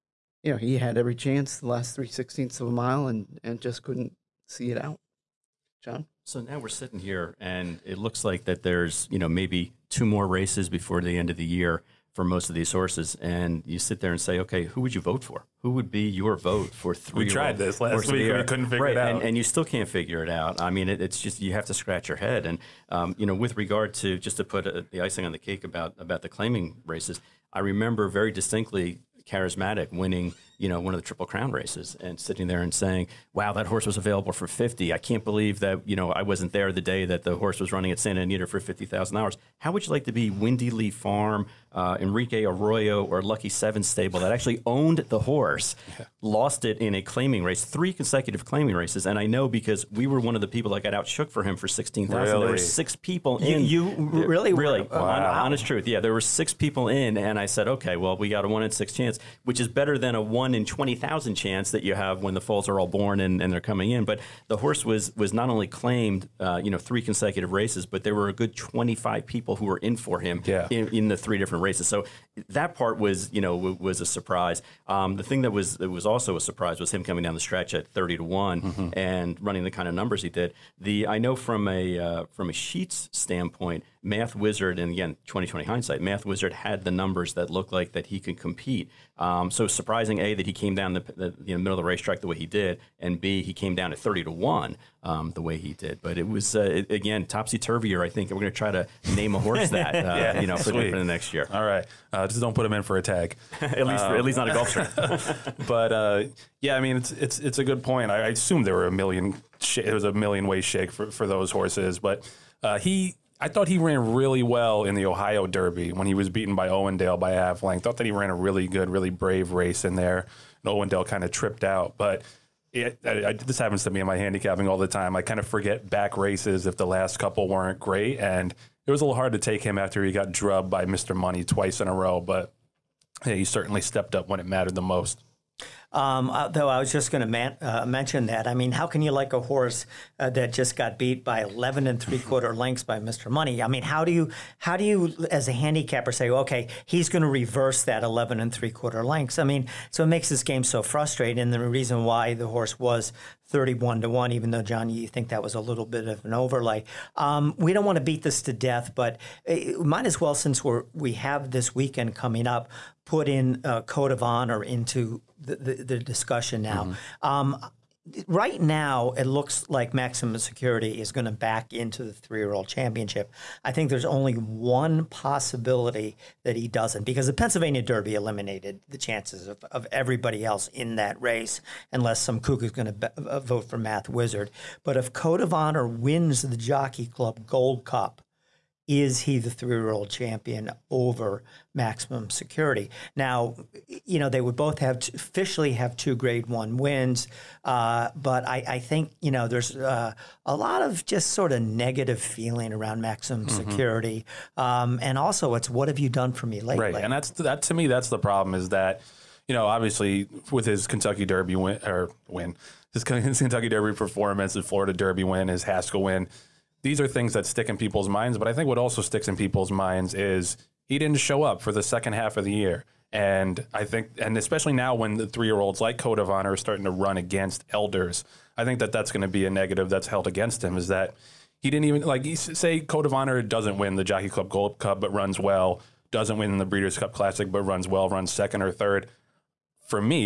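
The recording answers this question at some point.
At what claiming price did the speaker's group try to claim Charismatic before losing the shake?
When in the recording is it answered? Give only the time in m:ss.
0:51.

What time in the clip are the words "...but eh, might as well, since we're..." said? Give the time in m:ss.
2:38.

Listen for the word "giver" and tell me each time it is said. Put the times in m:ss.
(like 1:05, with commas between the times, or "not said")
not said.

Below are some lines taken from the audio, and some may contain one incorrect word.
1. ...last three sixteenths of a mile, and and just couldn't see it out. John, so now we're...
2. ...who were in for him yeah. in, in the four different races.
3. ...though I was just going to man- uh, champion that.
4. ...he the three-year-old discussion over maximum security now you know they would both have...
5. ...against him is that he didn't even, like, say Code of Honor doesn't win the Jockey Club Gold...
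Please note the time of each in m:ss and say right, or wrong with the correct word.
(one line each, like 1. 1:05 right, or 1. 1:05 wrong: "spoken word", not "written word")
1. 0:01 right
2. 1:09 wrong: "three", not "four"
3. 2:16 wrong: "mention", not "champion"
4. 3:09 wrong: "champion", not "discussion"
5. 3:50 right.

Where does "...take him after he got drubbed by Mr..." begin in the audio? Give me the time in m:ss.
2:09.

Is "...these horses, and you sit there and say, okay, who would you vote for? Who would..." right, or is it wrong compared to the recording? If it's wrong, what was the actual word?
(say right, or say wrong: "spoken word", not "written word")
right.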